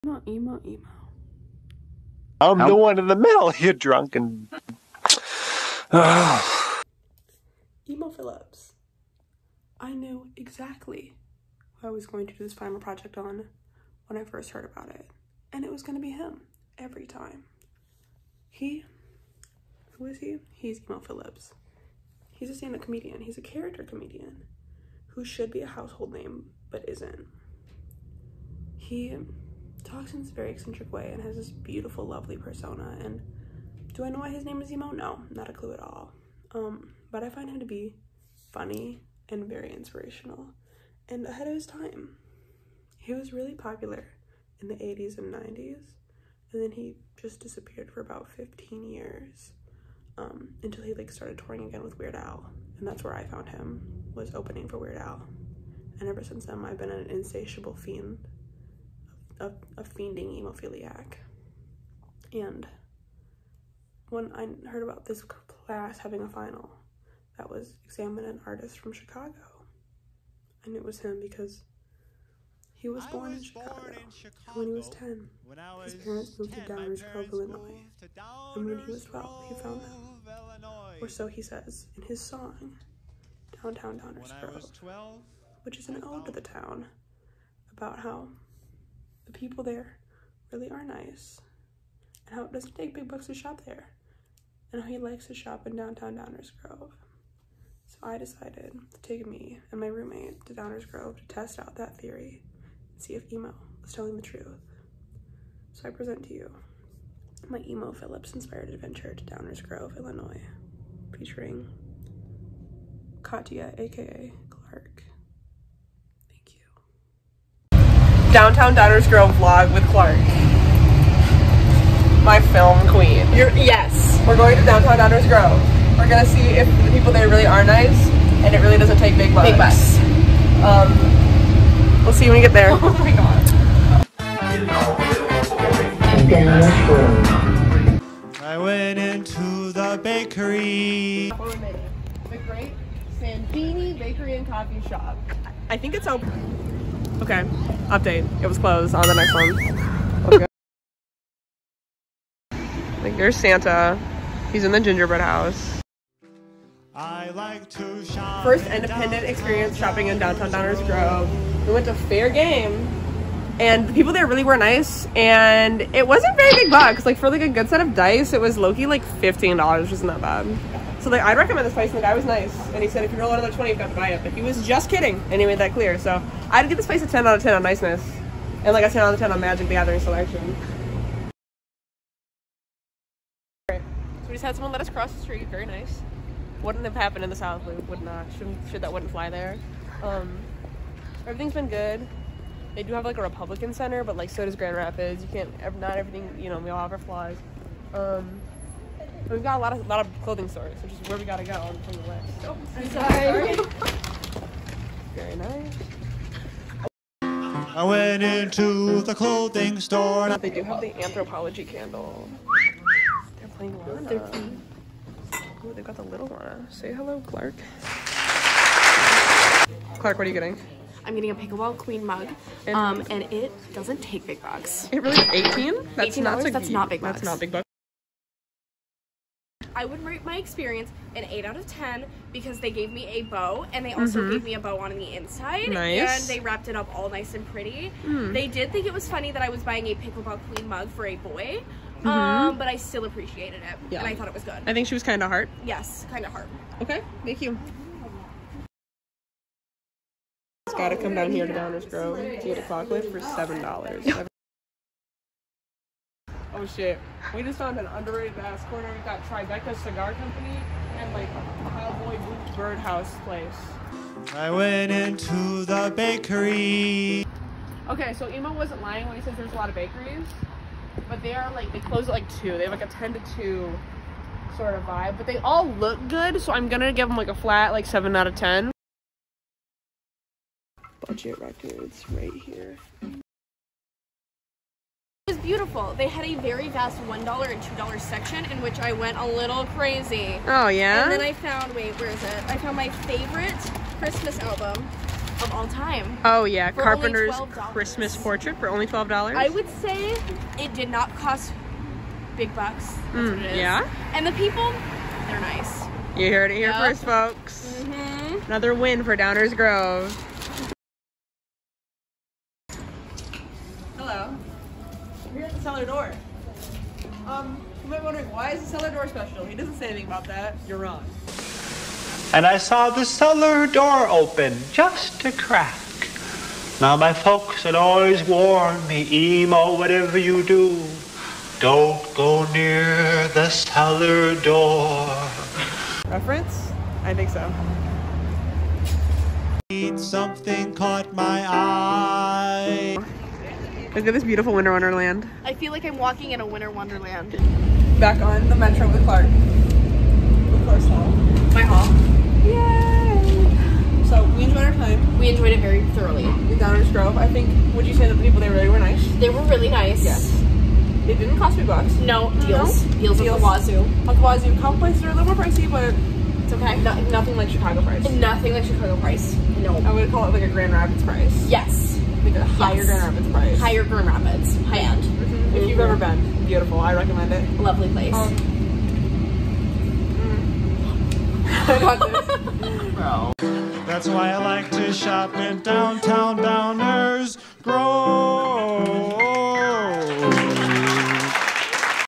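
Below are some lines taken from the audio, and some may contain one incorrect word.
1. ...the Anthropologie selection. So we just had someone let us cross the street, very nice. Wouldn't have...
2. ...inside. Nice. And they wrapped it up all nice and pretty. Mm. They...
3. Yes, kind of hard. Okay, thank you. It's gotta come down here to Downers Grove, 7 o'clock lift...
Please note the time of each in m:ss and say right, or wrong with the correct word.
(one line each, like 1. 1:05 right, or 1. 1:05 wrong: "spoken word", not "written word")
1. 2:59 wrong: "Gathering", not "Anthropologie"
2. 3:55 right
3. 4:05 wrong: "8", not "7".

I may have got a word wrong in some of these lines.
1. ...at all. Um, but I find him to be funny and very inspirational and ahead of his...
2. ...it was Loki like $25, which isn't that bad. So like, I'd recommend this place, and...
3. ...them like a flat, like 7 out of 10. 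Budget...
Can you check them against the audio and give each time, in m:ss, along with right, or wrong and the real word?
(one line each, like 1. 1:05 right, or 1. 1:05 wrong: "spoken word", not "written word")
1. 0:35 right
2. 2:48 wrong: "15", not "25"
3. 4:37 right.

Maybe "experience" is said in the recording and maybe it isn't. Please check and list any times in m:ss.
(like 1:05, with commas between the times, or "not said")
2:39, 3:50.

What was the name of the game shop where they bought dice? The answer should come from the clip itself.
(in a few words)
Fair Game.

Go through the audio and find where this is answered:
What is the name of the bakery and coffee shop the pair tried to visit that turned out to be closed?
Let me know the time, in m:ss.
2:22.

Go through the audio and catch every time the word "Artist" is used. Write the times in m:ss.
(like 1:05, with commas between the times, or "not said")
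1:08.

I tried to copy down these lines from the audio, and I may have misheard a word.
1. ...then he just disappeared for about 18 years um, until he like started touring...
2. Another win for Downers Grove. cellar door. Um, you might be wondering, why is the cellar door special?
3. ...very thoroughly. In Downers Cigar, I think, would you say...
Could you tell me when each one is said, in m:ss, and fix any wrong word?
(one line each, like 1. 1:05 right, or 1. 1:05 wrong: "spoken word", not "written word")
1. 0:46 wrong: "15", not "18"
2. 5:08 right
3. 5:55 wrong: "Grove", not "Cigar".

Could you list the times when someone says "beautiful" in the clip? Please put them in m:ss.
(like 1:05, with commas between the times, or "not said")
0:31, 4:45, 5:44, 6:16.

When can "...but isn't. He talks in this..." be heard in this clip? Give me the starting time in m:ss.
0:26.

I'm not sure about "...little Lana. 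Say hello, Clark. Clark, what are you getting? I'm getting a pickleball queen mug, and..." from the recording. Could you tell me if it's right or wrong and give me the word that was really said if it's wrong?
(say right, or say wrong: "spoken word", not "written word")
right.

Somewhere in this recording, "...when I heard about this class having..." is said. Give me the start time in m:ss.
1:04.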